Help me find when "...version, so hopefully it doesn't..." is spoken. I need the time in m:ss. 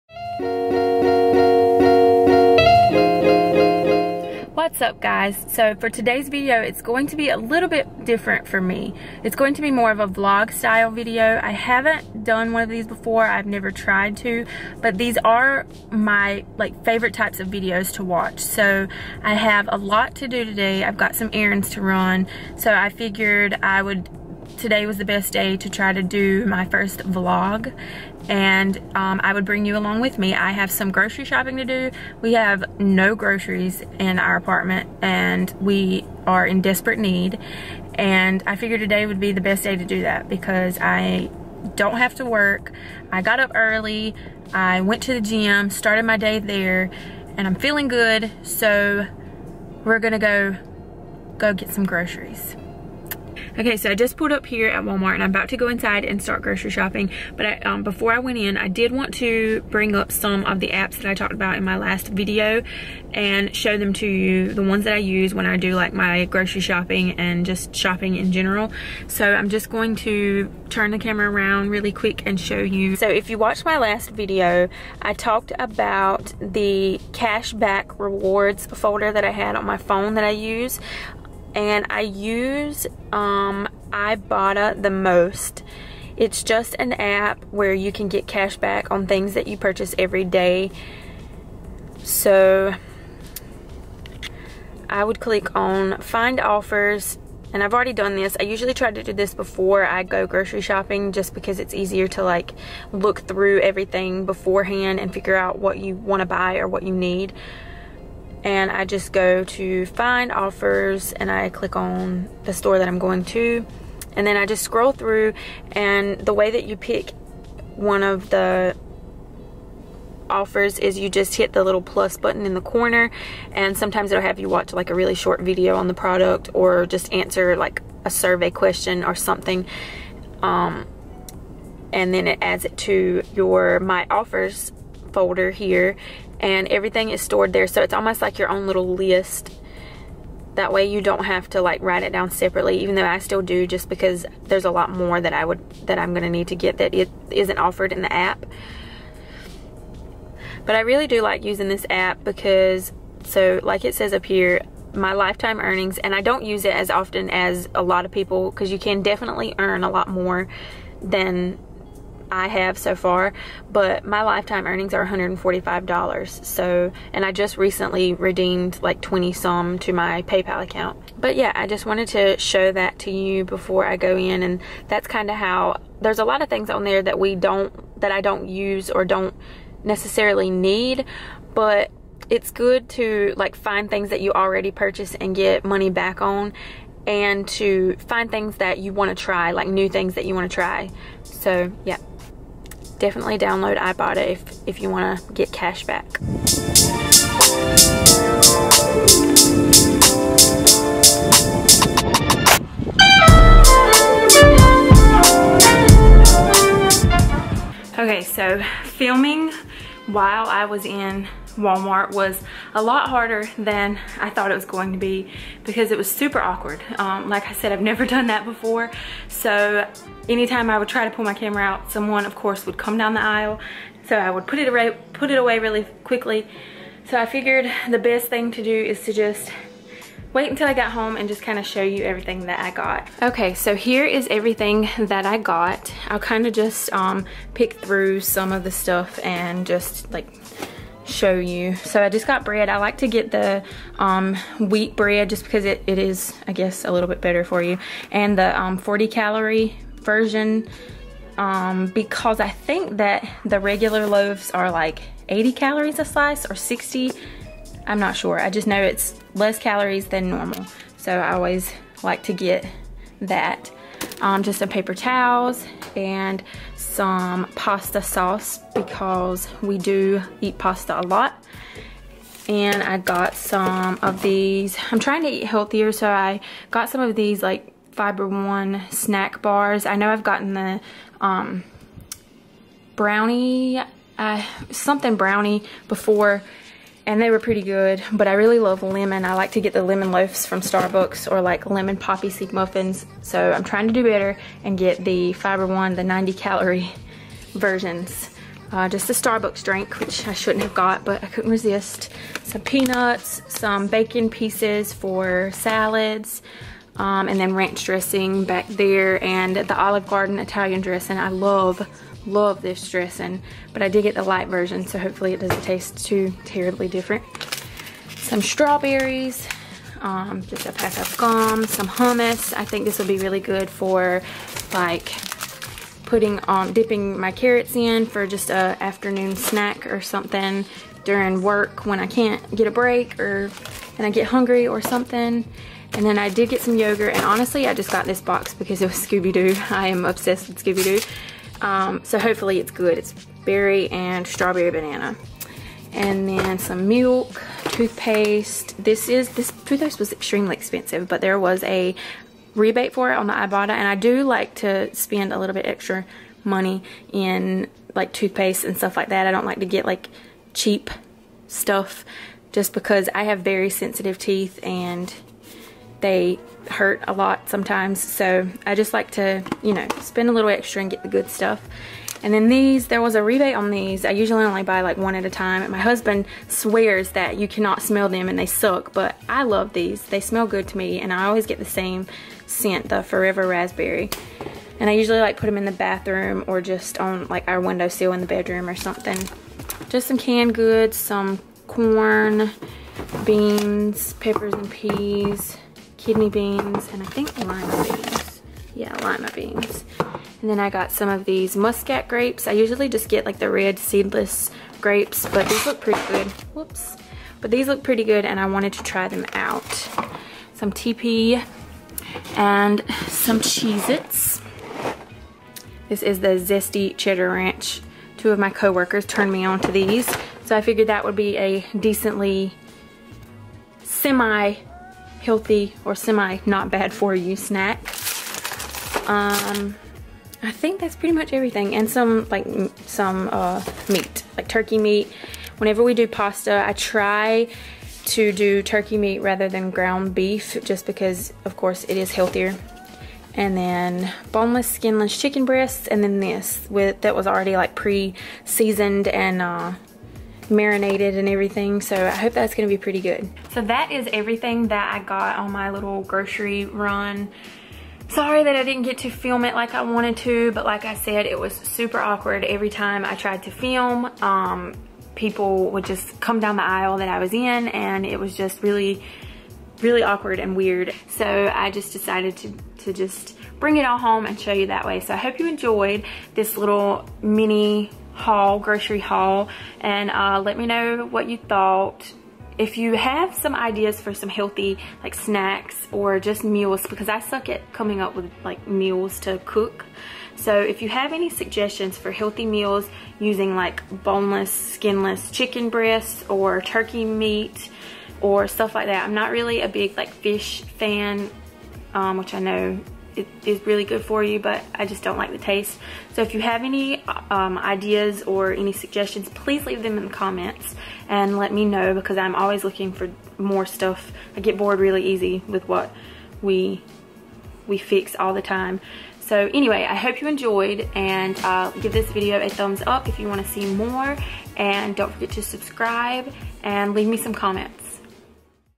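5:14.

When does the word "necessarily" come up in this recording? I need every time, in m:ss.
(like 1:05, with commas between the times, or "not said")
2:59.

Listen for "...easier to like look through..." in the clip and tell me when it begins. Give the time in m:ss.
1:41.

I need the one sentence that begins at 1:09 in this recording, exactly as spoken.
So I'm just going to turn the camera around really quick and show you.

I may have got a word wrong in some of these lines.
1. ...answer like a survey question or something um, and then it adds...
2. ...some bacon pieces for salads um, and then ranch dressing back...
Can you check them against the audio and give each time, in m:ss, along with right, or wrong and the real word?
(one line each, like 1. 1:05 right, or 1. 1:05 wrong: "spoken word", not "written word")
1. 2:07 right
2. 5:03 right.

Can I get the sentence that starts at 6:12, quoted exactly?
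And then these, there was a rebate on these.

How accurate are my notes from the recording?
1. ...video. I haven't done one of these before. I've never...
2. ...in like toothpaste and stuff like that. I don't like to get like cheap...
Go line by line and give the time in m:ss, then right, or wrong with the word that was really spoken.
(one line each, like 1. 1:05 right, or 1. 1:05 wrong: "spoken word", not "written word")
1. 0:10 right
2. 5:57 right.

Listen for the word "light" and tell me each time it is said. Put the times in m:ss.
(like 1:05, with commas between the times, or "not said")
5:14.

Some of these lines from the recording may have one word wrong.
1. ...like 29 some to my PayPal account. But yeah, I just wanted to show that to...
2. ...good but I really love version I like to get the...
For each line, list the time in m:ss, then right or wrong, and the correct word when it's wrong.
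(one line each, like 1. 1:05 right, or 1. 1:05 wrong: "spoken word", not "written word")
1. 2:48 wrong: "20", not "29"
2. 4:47 wrong: "lemon", not "version".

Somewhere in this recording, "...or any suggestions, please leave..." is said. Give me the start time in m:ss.
8:28.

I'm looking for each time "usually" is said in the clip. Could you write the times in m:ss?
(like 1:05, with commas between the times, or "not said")
1:38, 6:14, 6:24, 6:42.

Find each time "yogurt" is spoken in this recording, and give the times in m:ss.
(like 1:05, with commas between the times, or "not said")
5:36.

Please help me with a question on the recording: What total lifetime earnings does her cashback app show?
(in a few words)
$145.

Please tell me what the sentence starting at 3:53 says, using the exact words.
Okay, so here is everything that I got.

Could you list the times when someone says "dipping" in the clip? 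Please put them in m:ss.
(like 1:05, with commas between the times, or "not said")
5:26.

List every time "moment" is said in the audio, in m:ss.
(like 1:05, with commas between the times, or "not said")
not said.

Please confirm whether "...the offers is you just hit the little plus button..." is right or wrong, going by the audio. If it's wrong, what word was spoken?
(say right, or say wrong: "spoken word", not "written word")
right.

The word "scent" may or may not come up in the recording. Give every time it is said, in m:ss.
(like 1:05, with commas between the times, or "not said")
6:22.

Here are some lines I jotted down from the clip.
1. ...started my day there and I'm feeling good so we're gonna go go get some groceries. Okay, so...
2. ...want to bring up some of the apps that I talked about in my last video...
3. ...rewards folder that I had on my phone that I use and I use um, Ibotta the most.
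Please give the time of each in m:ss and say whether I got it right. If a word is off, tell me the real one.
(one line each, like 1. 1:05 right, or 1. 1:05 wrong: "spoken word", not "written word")
1. 0:45 right
2. 0:58 right
3. 1:17 right.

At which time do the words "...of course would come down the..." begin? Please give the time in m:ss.
3:42.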